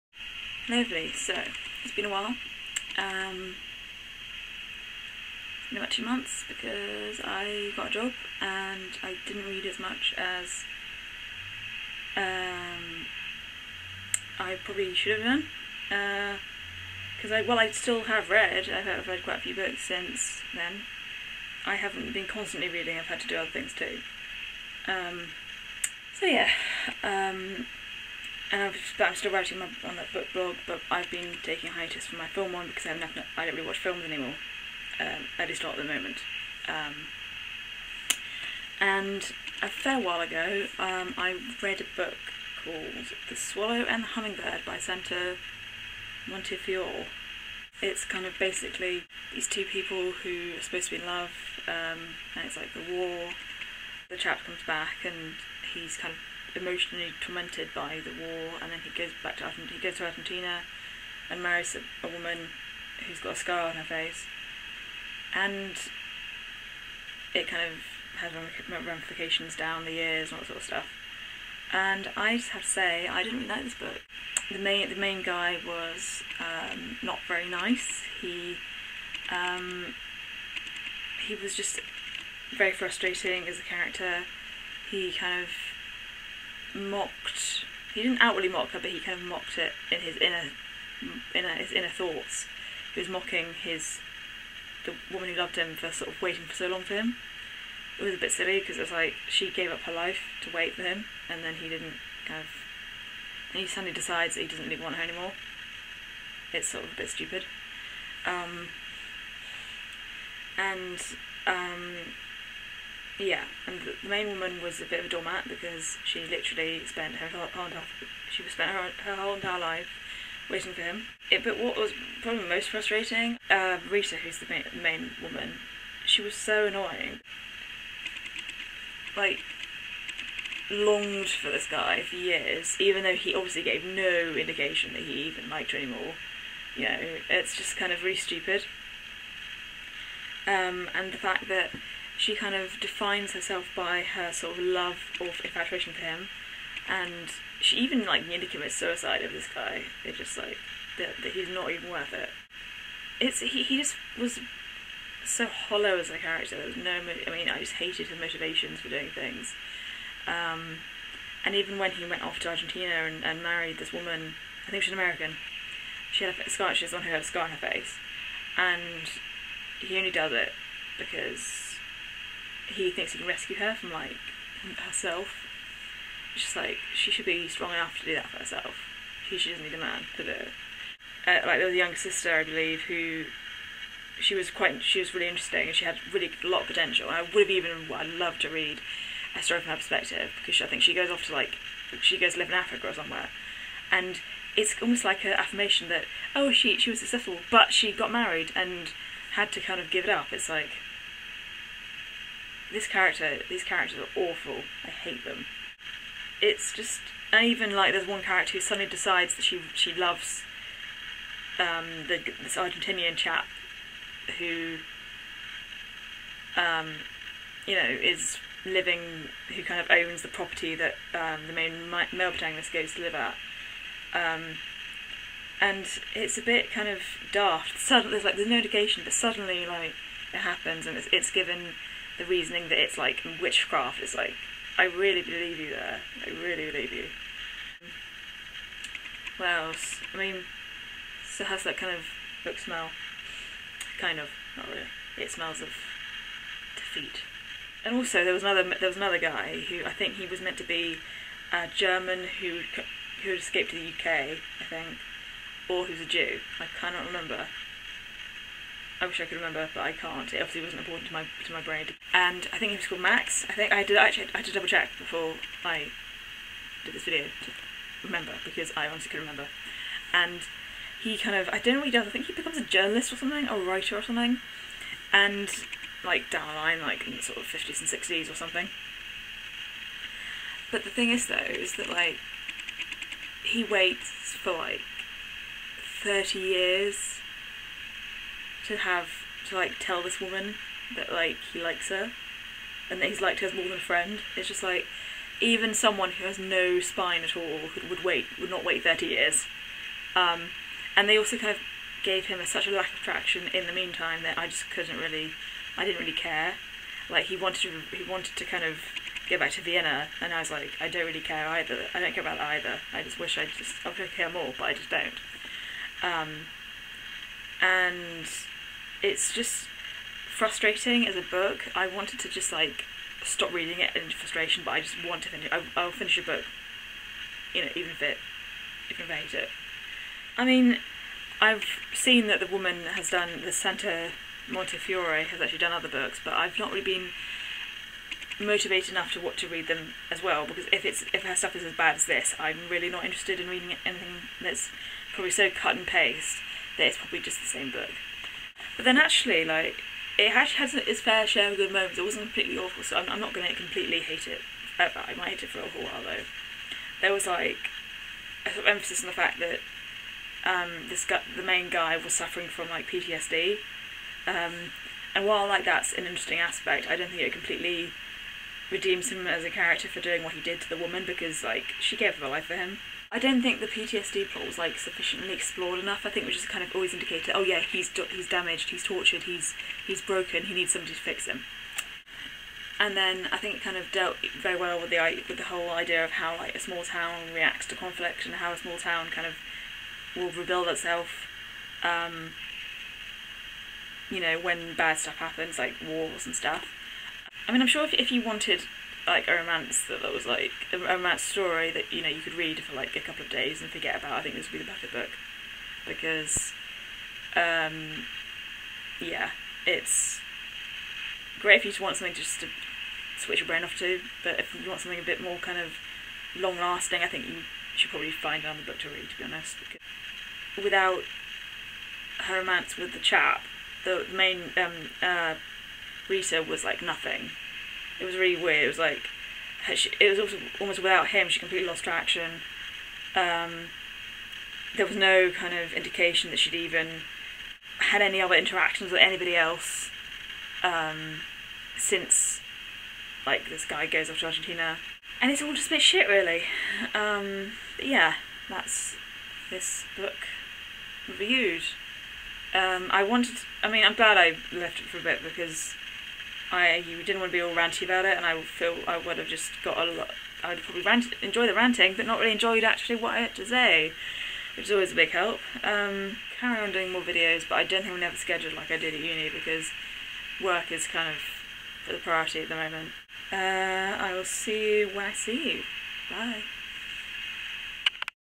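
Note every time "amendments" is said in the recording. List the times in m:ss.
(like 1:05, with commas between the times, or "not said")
not said.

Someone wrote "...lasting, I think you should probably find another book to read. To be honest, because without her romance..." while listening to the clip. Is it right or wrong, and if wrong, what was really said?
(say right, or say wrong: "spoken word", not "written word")
right.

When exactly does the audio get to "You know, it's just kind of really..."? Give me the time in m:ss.
2:16.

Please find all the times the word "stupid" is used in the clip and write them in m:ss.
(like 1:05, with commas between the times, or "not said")
1:47, 2:18.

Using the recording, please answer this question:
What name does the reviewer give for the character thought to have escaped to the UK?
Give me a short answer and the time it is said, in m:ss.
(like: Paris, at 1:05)
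Max, at 4:23.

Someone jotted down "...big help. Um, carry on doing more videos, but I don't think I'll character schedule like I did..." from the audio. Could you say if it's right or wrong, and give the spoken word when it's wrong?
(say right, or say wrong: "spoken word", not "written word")
wrong: "never", not "character".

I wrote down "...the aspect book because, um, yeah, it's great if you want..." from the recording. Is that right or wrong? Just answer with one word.
wrong.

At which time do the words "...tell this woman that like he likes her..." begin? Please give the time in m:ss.
4:49.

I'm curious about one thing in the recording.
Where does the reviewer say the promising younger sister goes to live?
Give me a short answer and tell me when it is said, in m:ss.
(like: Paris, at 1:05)
Africa, at 3:12.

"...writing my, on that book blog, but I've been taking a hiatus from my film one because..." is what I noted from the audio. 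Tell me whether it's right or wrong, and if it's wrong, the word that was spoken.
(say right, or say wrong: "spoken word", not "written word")
right.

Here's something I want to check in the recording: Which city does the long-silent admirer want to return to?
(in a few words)
Vienna.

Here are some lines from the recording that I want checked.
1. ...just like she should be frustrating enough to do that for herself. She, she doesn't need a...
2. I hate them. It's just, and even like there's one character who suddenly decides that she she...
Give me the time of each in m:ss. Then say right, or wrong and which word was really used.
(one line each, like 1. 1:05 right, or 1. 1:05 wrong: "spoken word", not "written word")
1. 2:56 wrong: "strong", not "frustrating"
2. 3:24 right.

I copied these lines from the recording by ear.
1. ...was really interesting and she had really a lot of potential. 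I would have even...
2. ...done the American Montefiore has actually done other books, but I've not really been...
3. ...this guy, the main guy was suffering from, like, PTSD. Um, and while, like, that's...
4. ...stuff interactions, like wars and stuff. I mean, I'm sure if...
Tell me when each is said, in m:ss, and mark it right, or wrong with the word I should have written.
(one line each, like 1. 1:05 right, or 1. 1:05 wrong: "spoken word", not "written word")
1. 3:04 right
2. 5:33 wrong: "Santa", not "American"
3. 6:00 right
4. 6:34 wrong: "happens", not "interactions".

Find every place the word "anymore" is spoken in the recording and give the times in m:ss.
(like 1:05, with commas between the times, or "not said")
0:34, 1:45, 2:15.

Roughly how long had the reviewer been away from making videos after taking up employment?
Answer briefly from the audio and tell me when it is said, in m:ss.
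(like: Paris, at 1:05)
2 months, at 0:05.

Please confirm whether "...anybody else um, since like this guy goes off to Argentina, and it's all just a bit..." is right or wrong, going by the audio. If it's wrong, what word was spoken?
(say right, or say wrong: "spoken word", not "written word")
right.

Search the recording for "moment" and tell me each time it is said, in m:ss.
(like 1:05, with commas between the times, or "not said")
0:35, 5:51, 7:52.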